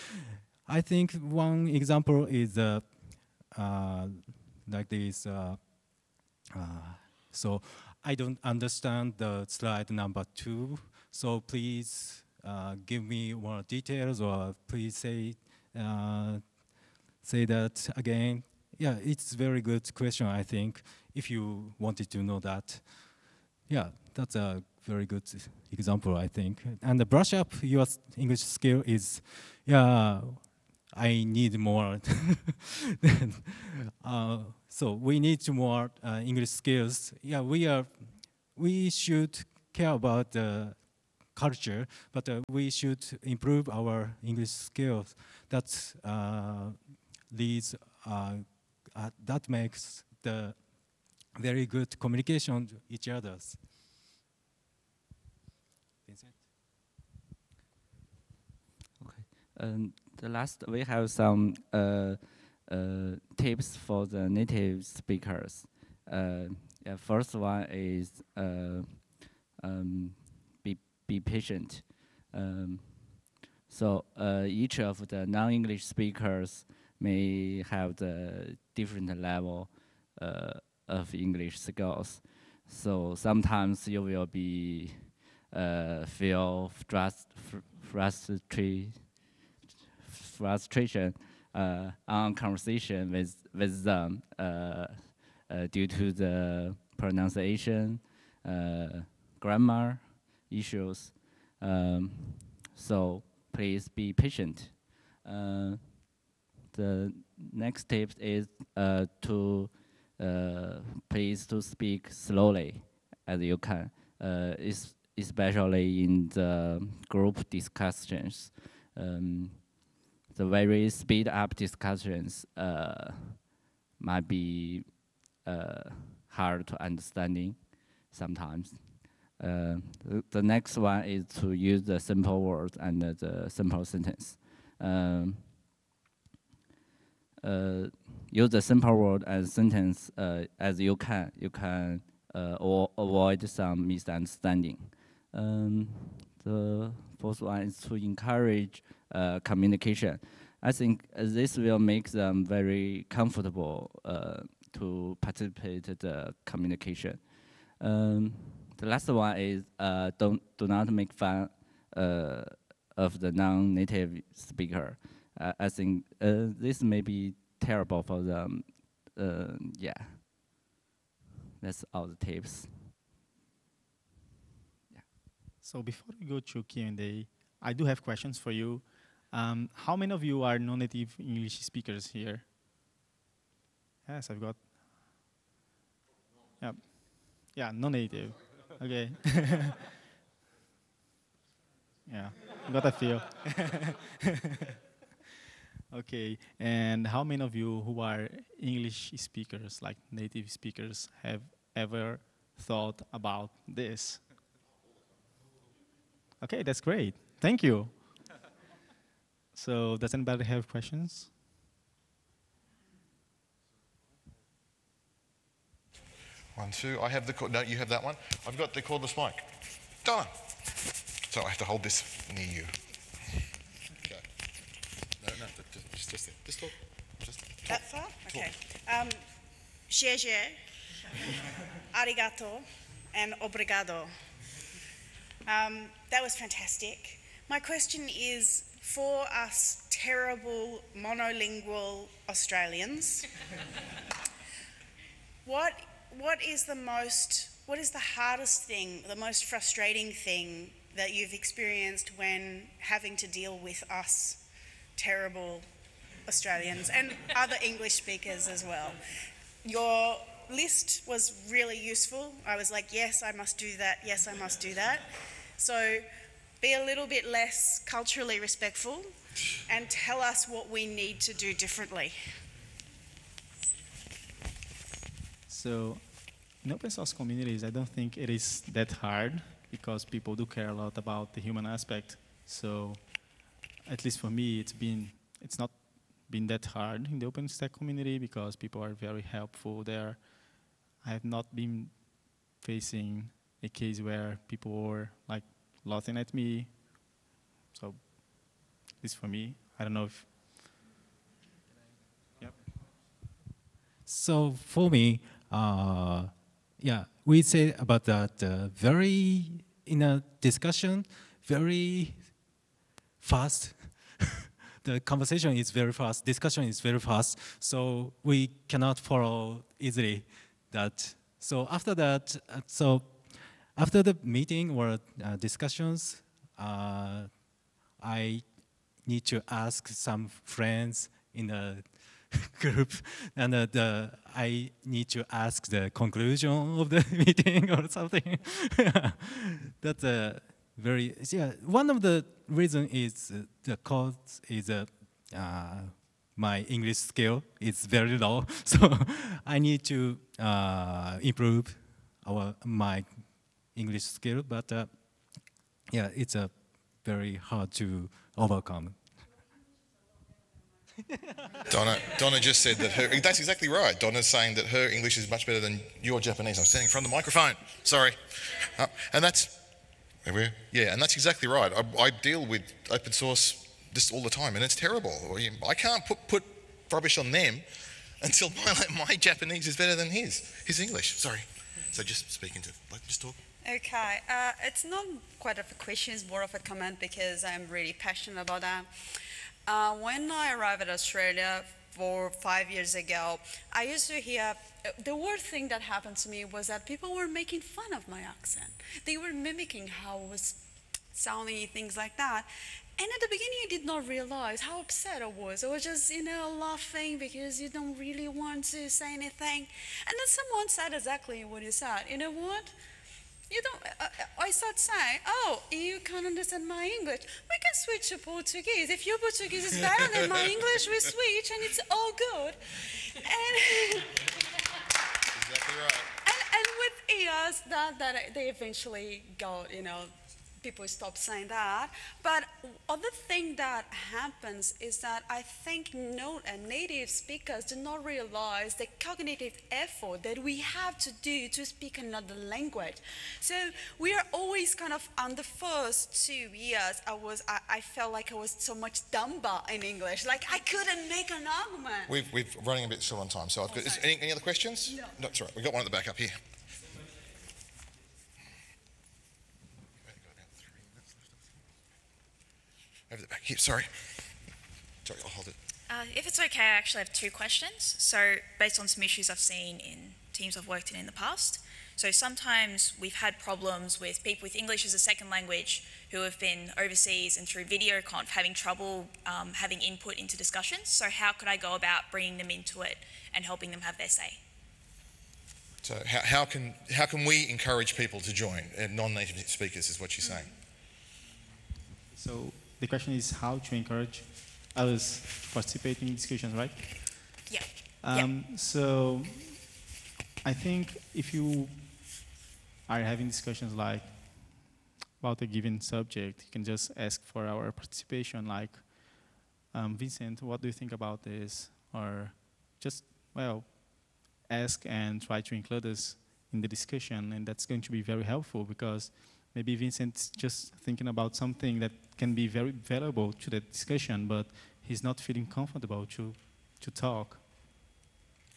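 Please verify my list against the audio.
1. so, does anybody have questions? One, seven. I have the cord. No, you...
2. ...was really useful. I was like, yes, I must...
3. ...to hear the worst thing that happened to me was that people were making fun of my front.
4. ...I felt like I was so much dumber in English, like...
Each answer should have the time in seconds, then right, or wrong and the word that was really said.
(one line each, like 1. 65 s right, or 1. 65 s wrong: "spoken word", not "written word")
1. 209 s wrong: "two", not "seven"
2. 261 s right
3. 394 s wrong: "accent", not "front"
4. 447 s right.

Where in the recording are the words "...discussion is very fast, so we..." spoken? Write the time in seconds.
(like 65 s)
316 s.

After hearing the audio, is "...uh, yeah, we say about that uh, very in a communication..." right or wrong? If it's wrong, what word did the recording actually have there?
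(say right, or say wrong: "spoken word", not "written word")
wrong: "discussion", not "communication".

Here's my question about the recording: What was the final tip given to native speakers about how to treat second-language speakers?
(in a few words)
Do not make fun.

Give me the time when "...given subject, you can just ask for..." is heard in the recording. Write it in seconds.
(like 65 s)
505 s.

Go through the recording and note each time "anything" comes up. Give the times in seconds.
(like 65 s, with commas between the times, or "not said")
409 s.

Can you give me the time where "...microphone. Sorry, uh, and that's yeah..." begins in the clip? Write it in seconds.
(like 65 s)
367 s.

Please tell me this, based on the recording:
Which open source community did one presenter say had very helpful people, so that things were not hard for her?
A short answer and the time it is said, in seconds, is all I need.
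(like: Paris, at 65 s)
OpenStack, at 287 s.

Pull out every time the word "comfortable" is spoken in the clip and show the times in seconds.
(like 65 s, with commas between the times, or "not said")
153 s, 525 s.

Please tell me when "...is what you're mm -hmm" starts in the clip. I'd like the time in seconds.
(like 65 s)
489 s.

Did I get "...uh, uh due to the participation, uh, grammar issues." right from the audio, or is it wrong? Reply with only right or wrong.
wrong.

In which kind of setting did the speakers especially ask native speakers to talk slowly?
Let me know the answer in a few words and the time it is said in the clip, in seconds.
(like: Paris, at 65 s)
Group discussions, at 117 s.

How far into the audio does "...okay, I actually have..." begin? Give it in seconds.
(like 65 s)
466 s.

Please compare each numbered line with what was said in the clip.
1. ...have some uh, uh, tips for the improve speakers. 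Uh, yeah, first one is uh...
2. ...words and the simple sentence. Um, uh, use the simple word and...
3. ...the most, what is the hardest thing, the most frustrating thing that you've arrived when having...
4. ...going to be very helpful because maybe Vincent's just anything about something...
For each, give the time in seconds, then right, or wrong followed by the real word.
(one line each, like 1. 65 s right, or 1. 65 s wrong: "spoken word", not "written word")
1. 60 s wrong: "native", not "improve"
2. 132 s right
3. 246 s wrong: "experienced", not "arrived"
4. 517 s wrong: "thinking", not "anything".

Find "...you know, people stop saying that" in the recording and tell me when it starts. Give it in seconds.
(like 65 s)
429 s.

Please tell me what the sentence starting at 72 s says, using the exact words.
Um, so uh, each of the non-English speakers may have the different level uh, of English skills.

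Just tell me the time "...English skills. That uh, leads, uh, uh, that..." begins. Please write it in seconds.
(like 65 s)
44 s.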